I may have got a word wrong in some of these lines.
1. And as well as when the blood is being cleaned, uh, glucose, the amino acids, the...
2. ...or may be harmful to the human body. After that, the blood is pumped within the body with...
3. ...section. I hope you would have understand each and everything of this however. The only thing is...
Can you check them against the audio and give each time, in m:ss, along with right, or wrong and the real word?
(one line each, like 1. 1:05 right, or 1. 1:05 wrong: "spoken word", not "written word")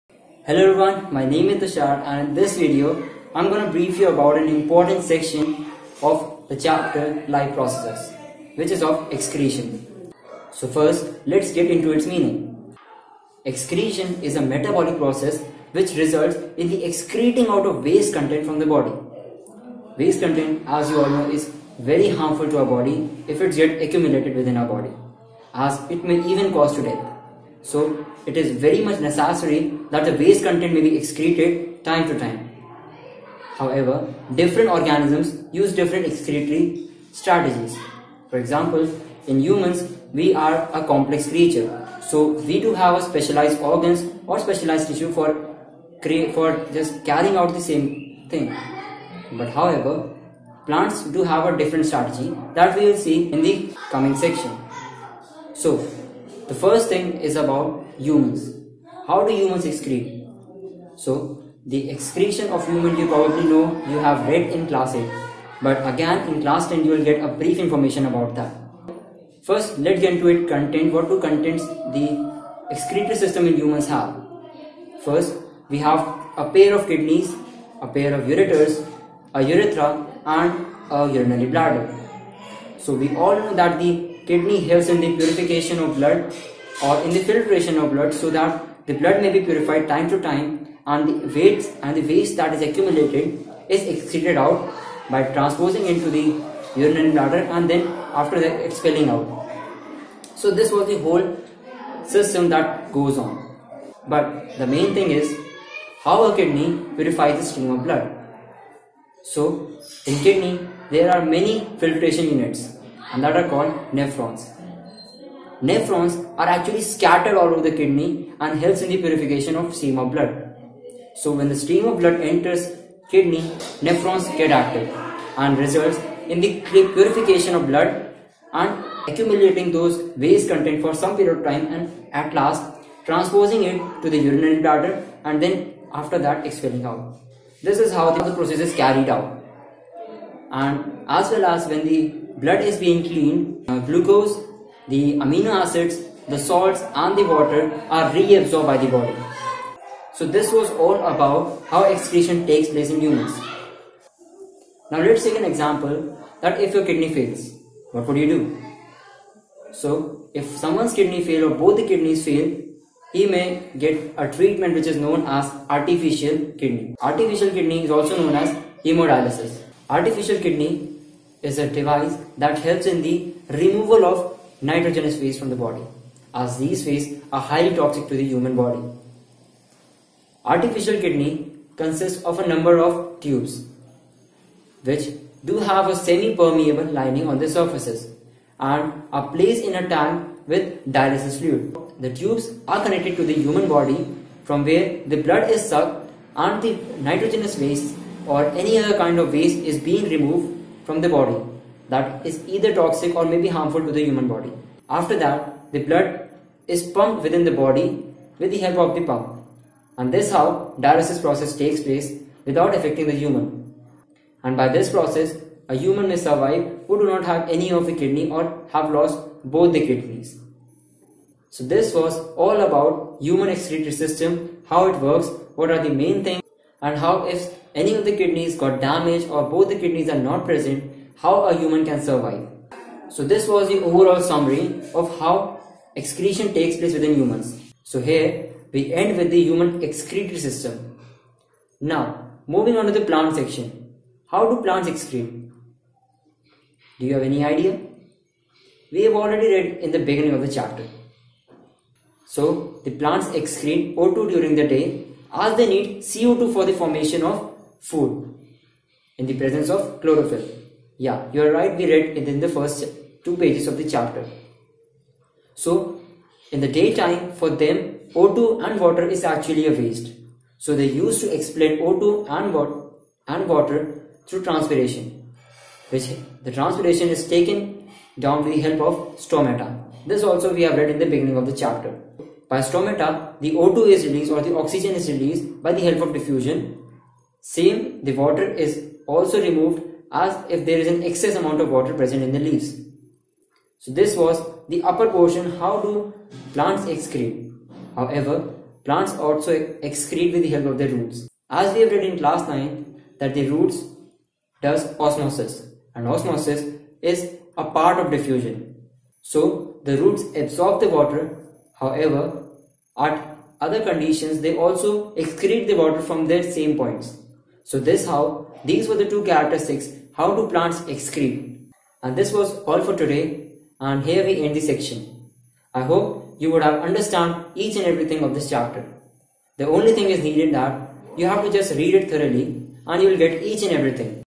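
1. 2:20 right
2. 3:23 right
3. 5:24 wrong: "chapter", not "however".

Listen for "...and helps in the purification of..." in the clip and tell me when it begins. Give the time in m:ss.
1:58.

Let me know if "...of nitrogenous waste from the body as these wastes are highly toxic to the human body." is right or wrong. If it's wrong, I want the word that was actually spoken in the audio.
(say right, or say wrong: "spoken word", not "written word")
right.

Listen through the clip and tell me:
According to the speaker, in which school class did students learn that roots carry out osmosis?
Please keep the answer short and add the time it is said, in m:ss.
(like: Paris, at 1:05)
Class 9, at 5:02.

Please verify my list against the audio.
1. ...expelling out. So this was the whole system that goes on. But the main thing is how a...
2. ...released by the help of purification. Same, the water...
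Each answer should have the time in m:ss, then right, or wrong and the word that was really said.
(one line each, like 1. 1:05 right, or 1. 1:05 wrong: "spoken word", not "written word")
1. 1:38 right
2. 4:45 wrong: "diffusion", not "purification".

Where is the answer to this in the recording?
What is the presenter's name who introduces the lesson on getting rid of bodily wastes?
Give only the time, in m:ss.
0:01.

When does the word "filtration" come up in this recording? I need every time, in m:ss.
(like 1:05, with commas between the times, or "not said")
1:27, 1:51.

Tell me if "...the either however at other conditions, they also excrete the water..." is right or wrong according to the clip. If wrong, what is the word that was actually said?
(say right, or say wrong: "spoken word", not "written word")
wrong: "water", not "either".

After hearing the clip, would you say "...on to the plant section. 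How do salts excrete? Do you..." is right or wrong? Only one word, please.
wrong.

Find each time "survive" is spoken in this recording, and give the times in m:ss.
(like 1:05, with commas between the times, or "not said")
3:36, 3:52.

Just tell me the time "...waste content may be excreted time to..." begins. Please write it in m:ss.
0:30.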